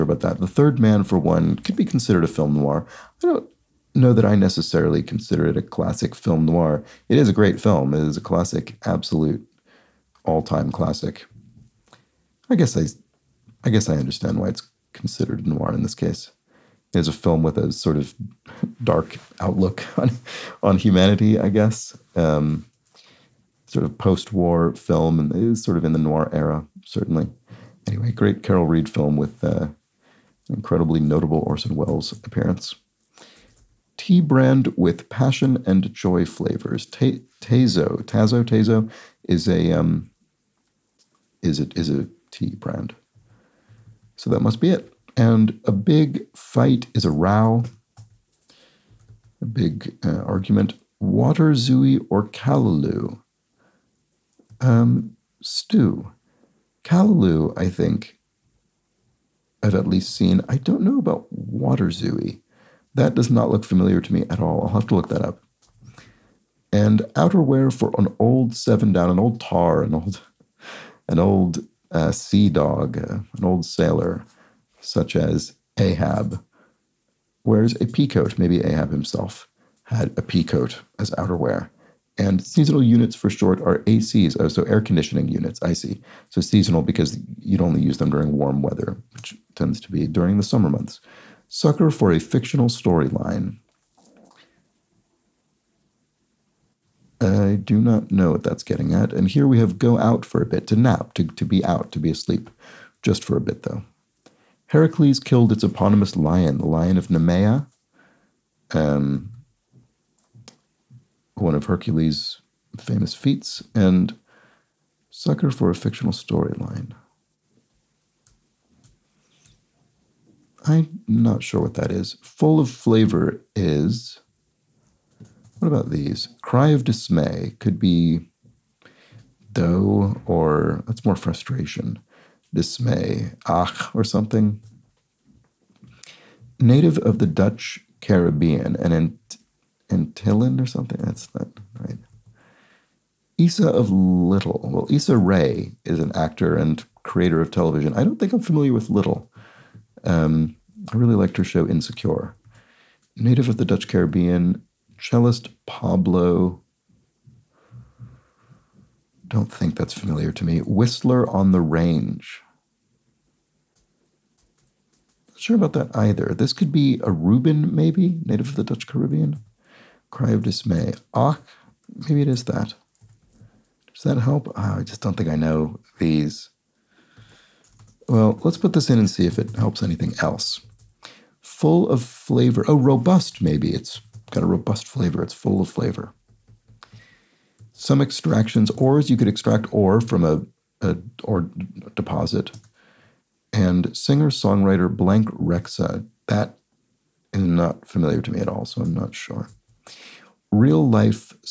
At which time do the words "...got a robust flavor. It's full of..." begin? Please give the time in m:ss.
3:04.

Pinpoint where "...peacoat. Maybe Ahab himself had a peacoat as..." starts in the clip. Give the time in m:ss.
1:17.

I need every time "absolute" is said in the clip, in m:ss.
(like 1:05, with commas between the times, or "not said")
0:08.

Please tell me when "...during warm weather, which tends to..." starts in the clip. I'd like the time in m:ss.
1:28.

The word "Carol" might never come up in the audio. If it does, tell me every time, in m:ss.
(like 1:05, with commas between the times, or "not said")
0:28.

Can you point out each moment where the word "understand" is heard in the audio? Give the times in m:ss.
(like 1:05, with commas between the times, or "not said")
0:13.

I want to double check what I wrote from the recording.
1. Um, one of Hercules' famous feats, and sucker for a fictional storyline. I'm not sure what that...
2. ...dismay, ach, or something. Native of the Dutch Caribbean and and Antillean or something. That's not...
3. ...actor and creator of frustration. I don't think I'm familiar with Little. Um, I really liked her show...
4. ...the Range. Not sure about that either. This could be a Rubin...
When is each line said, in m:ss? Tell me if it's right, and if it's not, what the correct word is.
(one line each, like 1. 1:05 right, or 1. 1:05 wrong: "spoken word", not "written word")
1. 1:48 right
2. 2:12 right
3. 2:26 wrong: "television", not "frustration"
4. 2:41 right.